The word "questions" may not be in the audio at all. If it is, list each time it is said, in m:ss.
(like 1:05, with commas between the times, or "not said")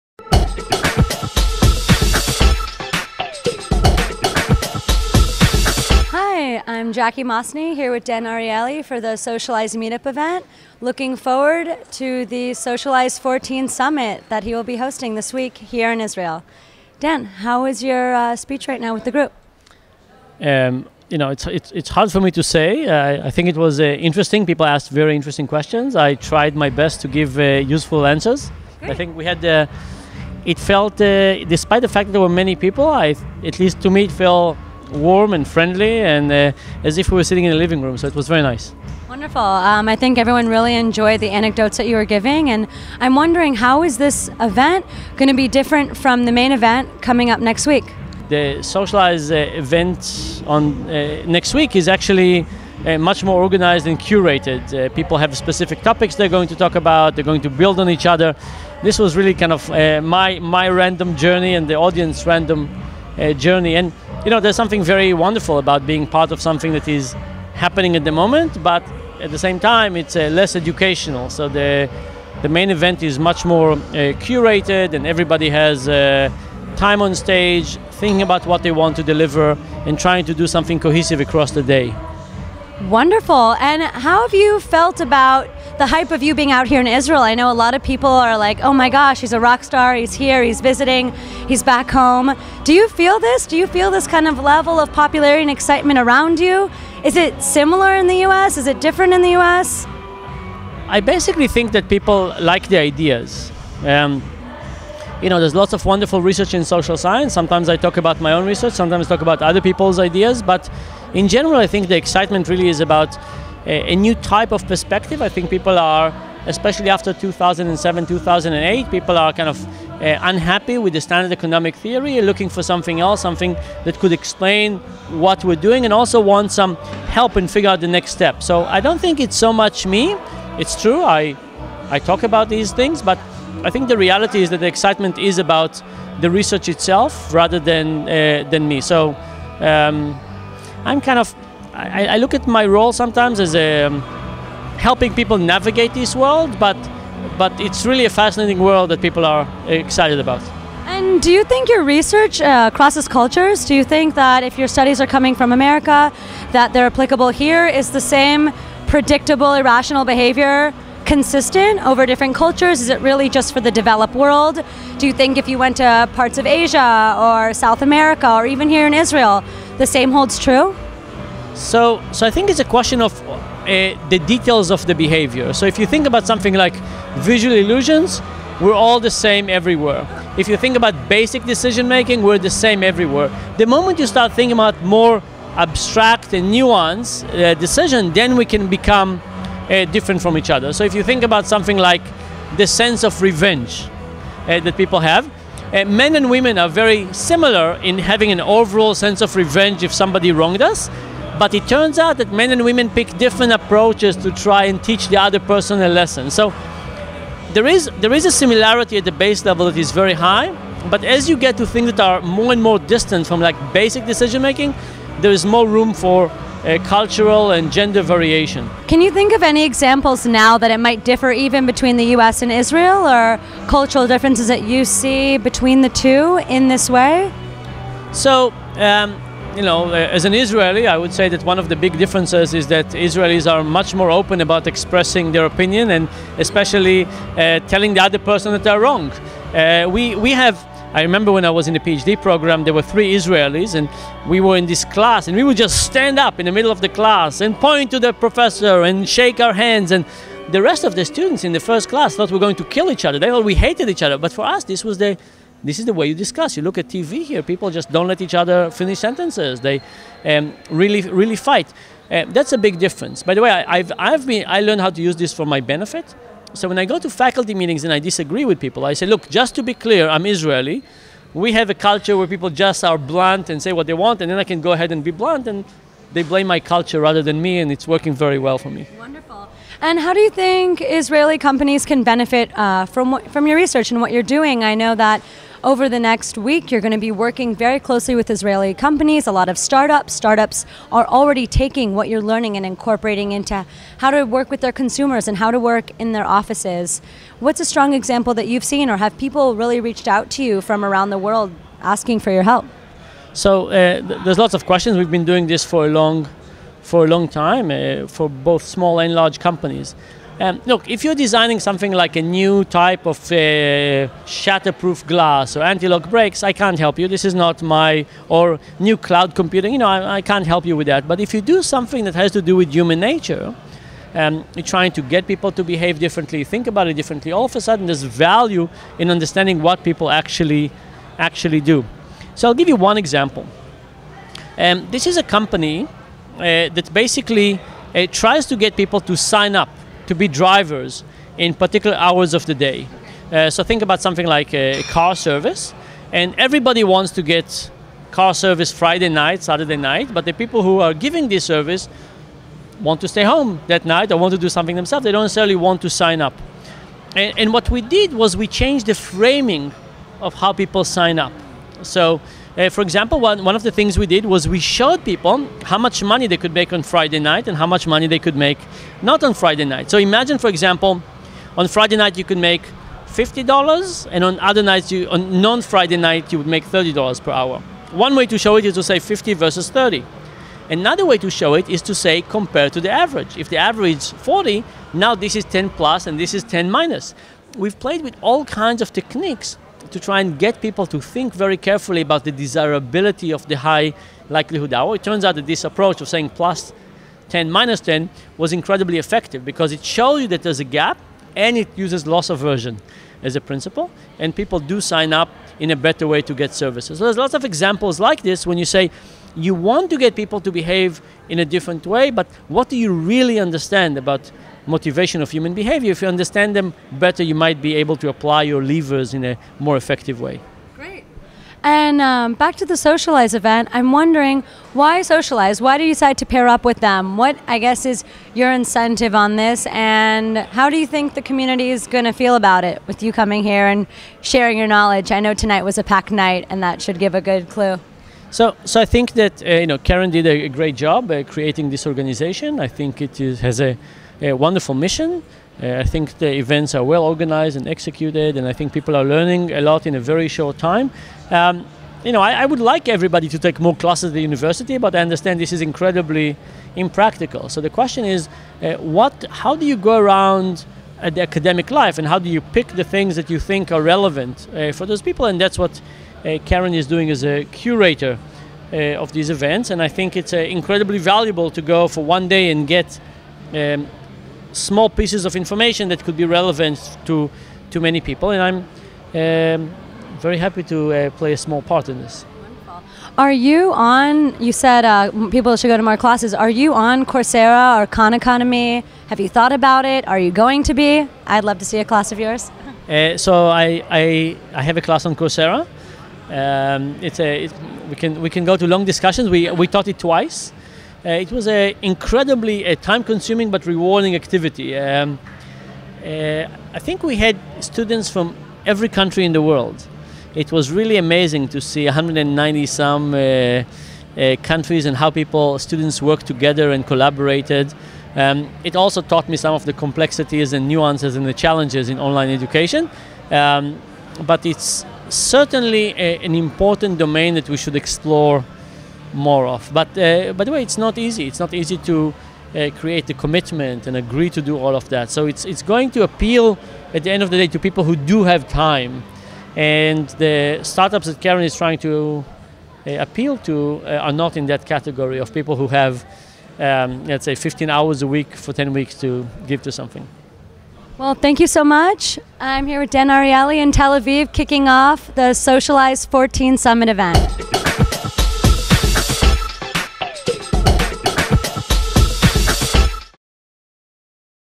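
0:25, 2:52, 5:04, 7:37.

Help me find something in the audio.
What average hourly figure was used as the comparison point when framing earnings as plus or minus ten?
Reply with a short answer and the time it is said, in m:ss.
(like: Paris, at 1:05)
40, at 6:24.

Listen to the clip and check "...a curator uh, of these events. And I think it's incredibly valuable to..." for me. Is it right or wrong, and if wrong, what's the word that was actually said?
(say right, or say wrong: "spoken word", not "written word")
right.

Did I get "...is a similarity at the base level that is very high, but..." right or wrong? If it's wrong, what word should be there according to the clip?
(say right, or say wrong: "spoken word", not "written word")
right.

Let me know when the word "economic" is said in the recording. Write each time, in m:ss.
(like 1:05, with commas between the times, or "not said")
2:01.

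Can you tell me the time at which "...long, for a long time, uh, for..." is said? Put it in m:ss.
5:05.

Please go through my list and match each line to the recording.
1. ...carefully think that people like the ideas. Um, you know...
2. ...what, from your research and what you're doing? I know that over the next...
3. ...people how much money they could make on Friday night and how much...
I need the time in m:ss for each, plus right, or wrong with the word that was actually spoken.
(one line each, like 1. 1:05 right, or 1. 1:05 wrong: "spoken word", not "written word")
1. 1:40 wrong: "basically", not "carefully"
2. 4:43 right
3. 6:05 right.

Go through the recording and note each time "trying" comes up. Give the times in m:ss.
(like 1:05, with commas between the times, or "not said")
1:19, 5:24, 9:01.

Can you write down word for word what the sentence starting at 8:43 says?
Um, but it's certainly a, uh, an important domain that we should explore more of.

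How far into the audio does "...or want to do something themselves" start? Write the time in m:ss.
5:54.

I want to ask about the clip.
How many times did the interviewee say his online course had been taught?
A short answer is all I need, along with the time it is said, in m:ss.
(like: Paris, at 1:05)
twice, at 8:19.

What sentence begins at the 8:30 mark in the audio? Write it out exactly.
It was really amazing to see 190 some uh, uh, countries and how people, students worked together and collaborated.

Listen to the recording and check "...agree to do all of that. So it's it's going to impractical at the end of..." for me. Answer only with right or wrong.
wrong.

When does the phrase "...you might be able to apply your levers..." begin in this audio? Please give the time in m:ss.
6:57.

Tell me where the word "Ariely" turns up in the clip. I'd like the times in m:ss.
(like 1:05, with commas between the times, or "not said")
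0:08, 9:13.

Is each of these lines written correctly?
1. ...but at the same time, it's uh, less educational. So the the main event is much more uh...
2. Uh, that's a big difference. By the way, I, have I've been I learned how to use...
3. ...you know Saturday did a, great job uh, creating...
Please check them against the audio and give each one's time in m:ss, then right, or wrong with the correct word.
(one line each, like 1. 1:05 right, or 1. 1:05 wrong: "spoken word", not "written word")
1. 1:08 right
2. 4:22 right
3. 7:19 wrong: "Keren", not "Saturday".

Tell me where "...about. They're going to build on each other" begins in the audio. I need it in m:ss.
0:56.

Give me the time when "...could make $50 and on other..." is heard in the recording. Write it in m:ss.
6:12.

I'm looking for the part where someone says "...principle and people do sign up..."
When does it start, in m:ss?
6:43.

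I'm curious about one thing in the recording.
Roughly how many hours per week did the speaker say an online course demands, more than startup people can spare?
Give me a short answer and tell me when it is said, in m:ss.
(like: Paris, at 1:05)
15, at 9:07.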